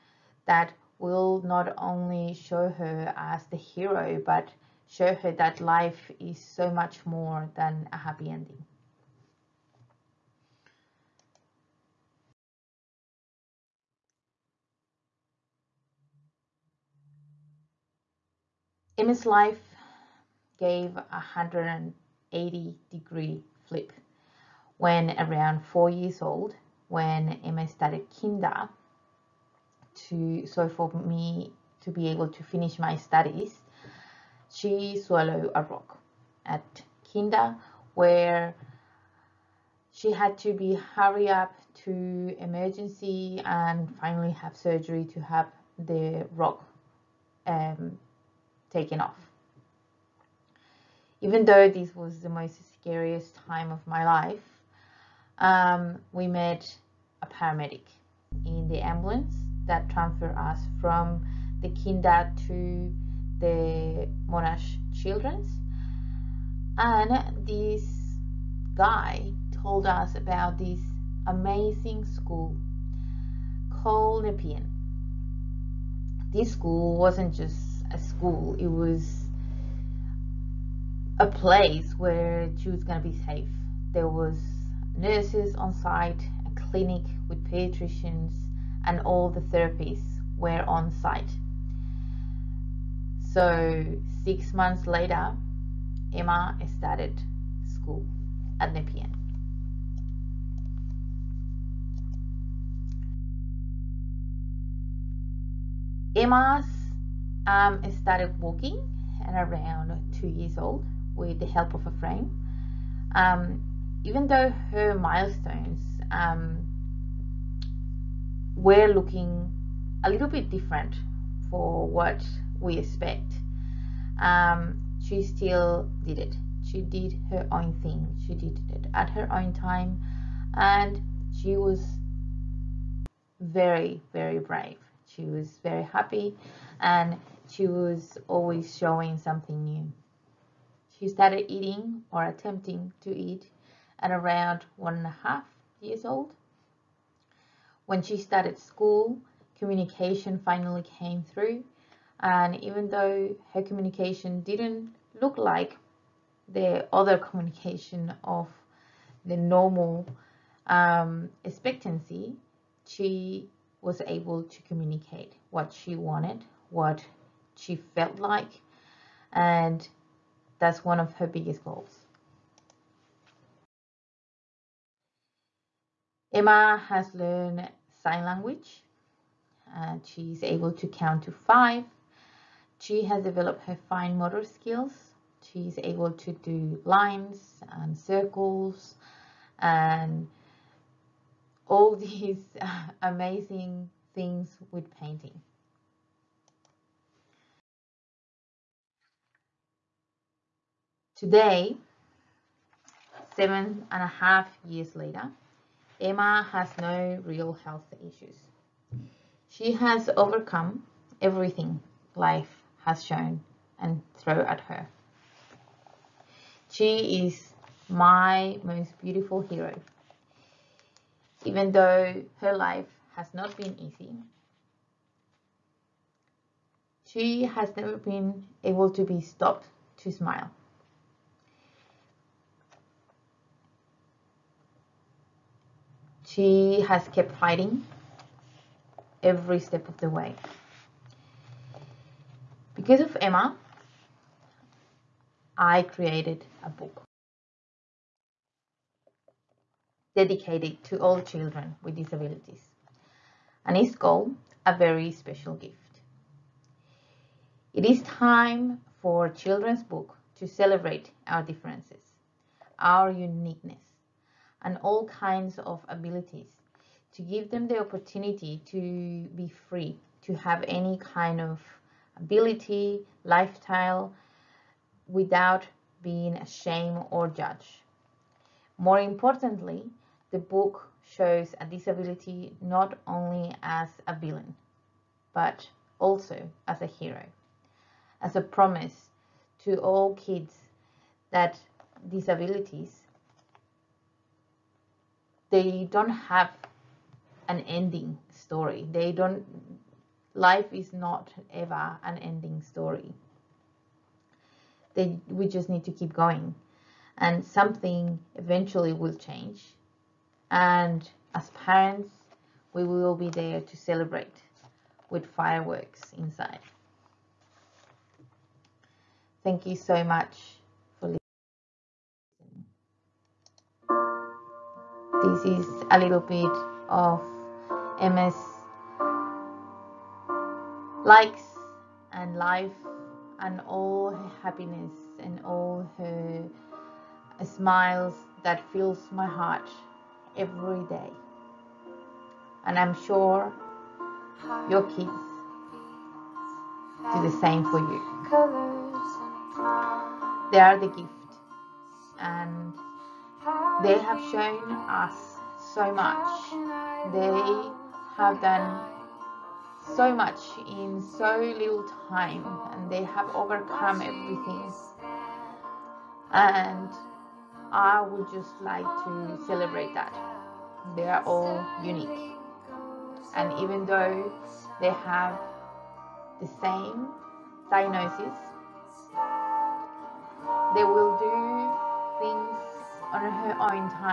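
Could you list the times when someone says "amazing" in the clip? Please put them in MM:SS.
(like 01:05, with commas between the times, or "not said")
01:11, 03:13.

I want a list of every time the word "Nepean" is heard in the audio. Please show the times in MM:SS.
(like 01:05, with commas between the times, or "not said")
01:14, 01:38.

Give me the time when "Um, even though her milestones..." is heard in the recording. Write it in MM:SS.
01:53.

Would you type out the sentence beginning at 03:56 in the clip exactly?
She has kept fighting every step of the way.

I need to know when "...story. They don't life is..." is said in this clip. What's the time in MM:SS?
04:58.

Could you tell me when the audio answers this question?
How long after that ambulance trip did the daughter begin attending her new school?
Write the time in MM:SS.
01:34.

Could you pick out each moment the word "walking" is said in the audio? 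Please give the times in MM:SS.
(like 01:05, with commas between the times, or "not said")
01:48.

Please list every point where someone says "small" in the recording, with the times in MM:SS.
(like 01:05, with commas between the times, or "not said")
not said.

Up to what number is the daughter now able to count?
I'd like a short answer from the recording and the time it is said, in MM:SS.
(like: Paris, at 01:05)
5, at 03:01.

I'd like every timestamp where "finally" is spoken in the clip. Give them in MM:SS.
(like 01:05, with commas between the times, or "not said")
00:43, 02:30.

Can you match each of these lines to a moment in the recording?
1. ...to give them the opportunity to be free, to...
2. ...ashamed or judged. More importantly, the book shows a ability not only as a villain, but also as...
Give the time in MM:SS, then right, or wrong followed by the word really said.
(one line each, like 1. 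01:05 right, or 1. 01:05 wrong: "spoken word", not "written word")
1. 04:27 right
2. 04:36 wrong: "disability", not "ability".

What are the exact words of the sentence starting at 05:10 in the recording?
And as parents, we will be there to celebrate with fireworks inside.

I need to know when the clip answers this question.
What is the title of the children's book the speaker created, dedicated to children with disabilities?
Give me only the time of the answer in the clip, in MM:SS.
04:14.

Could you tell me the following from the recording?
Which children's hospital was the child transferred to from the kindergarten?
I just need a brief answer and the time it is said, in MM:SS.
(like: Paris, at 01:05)
Monash Children's, at 01:04.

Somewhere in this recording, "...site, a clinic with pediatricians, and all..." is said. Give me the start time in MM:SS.
01:25.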